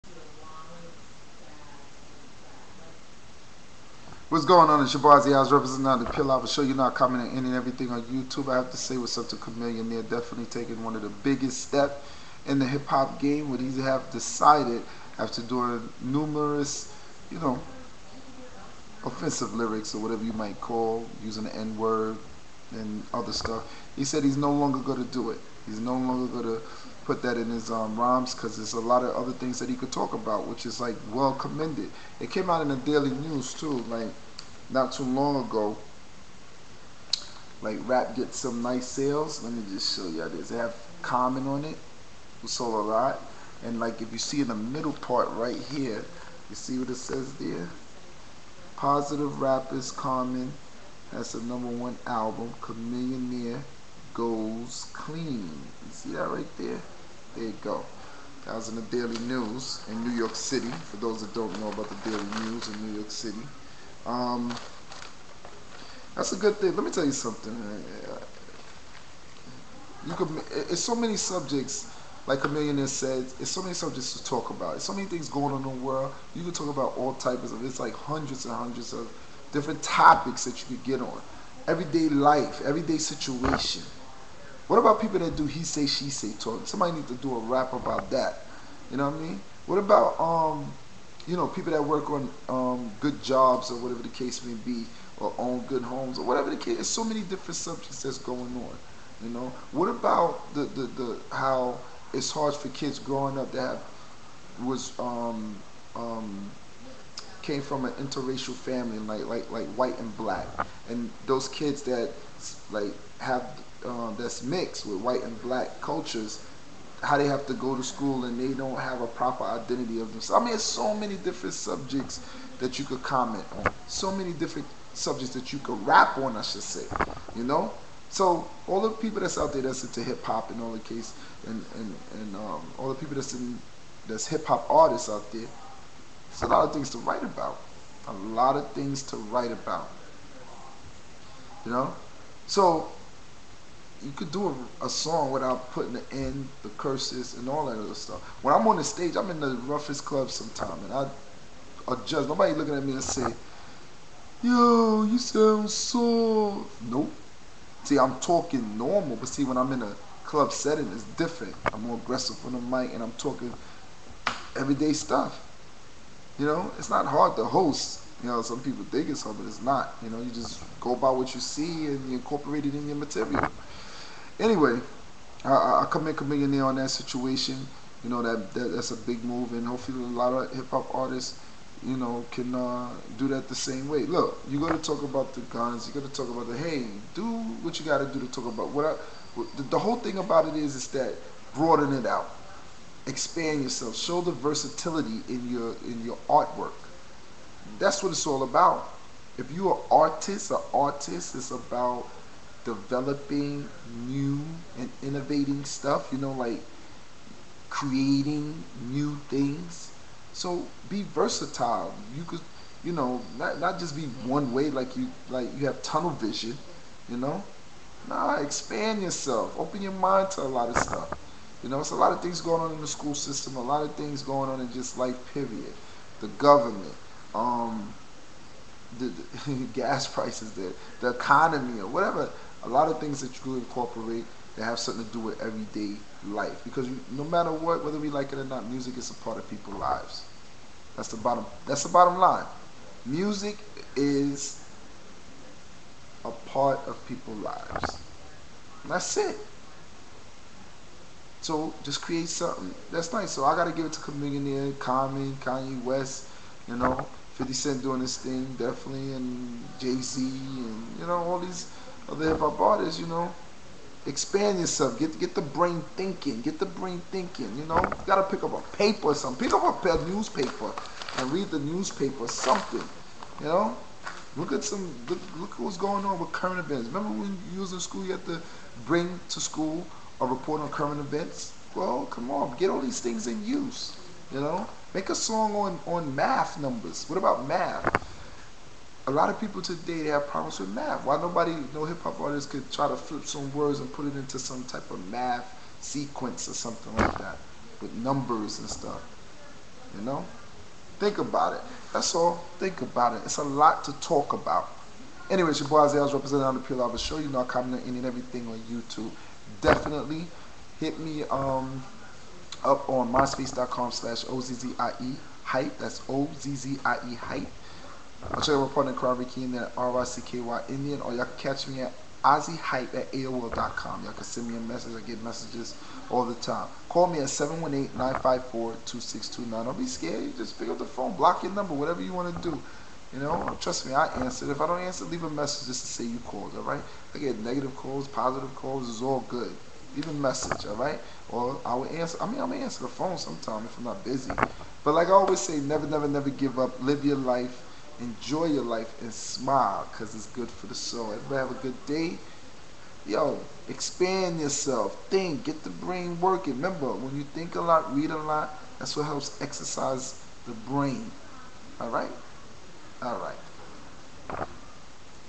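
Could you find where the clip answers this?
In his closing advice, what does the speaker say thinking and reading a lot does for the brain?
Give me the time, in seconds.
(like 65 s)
359 s.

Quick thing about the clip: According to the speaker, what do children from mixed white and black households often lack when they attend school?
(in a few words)
a proper identity.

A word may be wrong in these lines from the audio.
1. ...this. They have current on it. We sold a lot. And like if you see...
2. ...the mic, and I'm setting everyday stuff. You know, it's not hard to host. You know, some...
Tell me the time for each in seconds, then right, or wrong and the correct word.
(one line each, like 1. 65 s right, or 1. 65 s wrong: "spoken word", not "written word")
1. 40 s wrong: "comment", not "current"
2. 162 s wrong: "talking", not "setting".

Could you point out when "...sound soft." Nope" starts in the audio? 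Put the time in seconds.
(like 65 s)
155 s.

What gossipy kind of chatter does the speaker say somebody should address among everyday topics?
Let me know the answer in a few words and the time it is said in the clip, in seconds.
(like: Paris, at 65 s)
he say she say talk, at 85 s.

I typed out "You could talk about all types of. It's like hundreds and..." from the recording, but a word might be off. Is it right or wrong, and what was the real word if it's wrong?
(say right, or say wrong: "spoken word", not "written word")
right.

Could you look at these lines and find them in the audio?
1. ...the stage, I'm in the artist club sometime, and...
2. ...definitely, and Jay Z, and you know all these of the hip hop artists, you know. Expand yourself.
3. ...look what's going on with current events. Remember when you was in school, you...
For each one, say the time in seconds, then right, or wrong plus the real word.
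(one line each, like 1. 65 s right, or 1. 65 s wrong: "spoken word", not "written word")
1. 148 s wrong: "roughest", not "artist"
2. 258 s right
3. 275 s right.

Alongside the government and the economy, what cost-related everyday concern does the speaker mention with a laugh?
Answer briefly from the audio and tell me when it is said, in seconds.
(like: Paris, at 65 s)
gas prices, at 229 s.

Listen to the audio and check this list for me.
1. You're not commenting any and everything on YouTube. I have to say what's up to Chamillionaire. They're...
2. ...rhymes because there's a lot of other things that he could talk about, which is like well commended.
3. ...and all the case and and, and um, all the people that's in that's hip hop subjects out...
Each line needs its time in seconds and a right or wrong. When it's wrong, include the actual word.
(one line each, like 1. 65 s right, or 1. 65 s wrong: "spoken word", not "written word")
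1. 6 s right
2. 27 s right
3. 130 s wrong: "artists", not "subjects".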